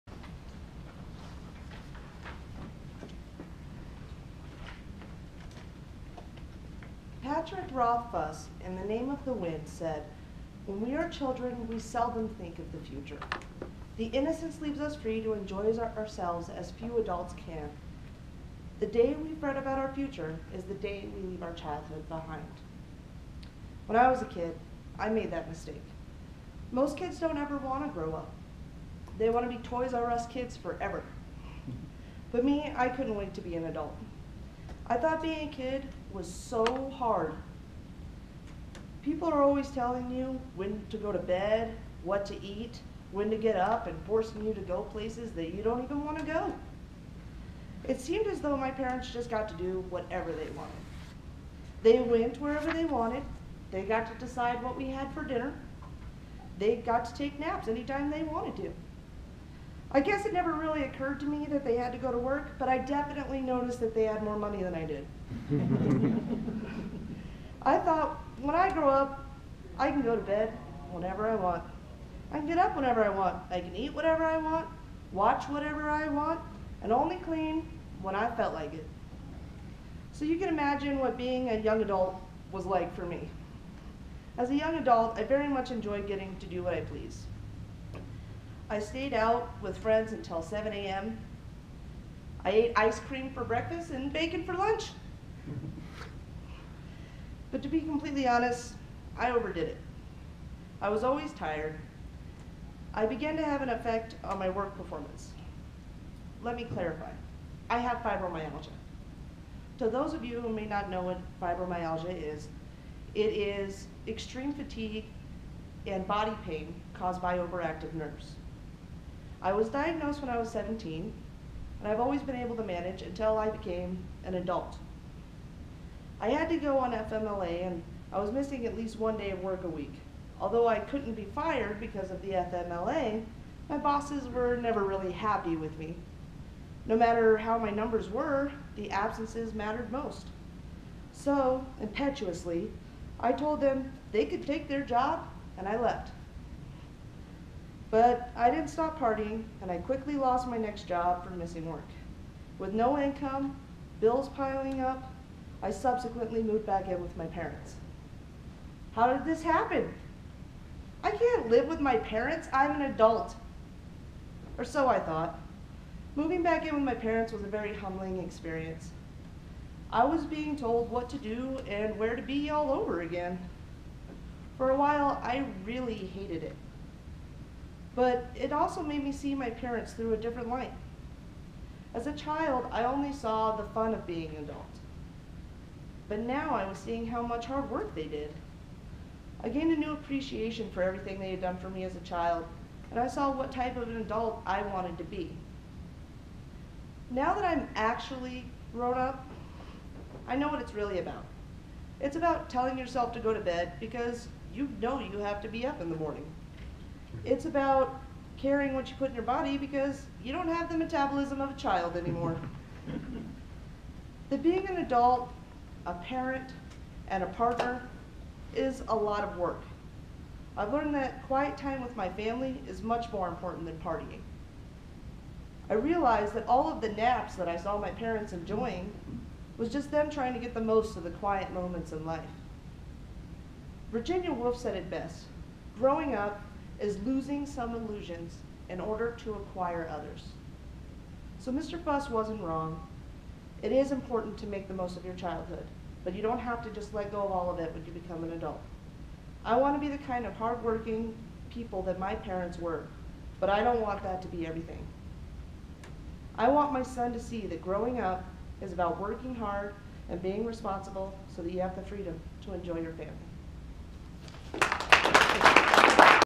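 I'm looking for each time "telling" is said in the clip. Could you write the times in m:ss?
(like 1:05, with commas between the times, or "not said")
0:39, 3:22.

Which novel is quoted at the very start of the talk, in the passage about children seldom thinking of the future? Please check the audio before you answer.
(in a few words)
The Name of the Wind.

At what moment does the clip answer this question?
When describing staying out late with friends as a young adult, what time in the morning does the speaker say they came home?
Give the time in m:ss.
1:30.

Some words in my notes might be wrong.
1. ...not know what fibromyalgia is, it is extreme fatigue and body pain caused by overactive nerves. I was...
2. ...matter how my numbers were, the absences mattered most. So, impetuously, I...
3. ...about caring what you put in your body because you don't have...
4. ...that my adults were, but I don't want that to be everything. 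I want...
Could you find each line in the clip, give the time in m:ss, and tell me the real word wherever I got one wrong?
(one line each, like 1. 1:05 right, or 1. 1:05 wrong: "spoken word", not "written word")
1. 1:50 right
2. 2:16 right
3. 3:27 right
4. 4:11 wrong: "parents", not "adults".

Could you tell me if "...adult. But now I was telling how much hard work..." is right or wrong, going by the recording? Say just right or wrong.
wrong.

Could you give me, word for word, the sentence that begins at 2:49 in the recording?
I was being told what to do and where to be all over again.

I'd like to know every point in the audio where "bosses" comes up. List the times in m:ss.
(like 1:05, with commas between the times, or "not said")
2:13.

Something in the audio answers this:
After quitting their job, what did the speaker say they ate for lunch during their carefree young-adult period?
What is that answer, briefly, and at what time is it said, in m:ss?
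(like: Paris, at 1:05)
bacon, at 1:34.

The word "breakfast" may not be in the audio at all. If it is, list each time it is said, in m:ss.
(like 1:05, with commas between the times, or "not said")
1:33.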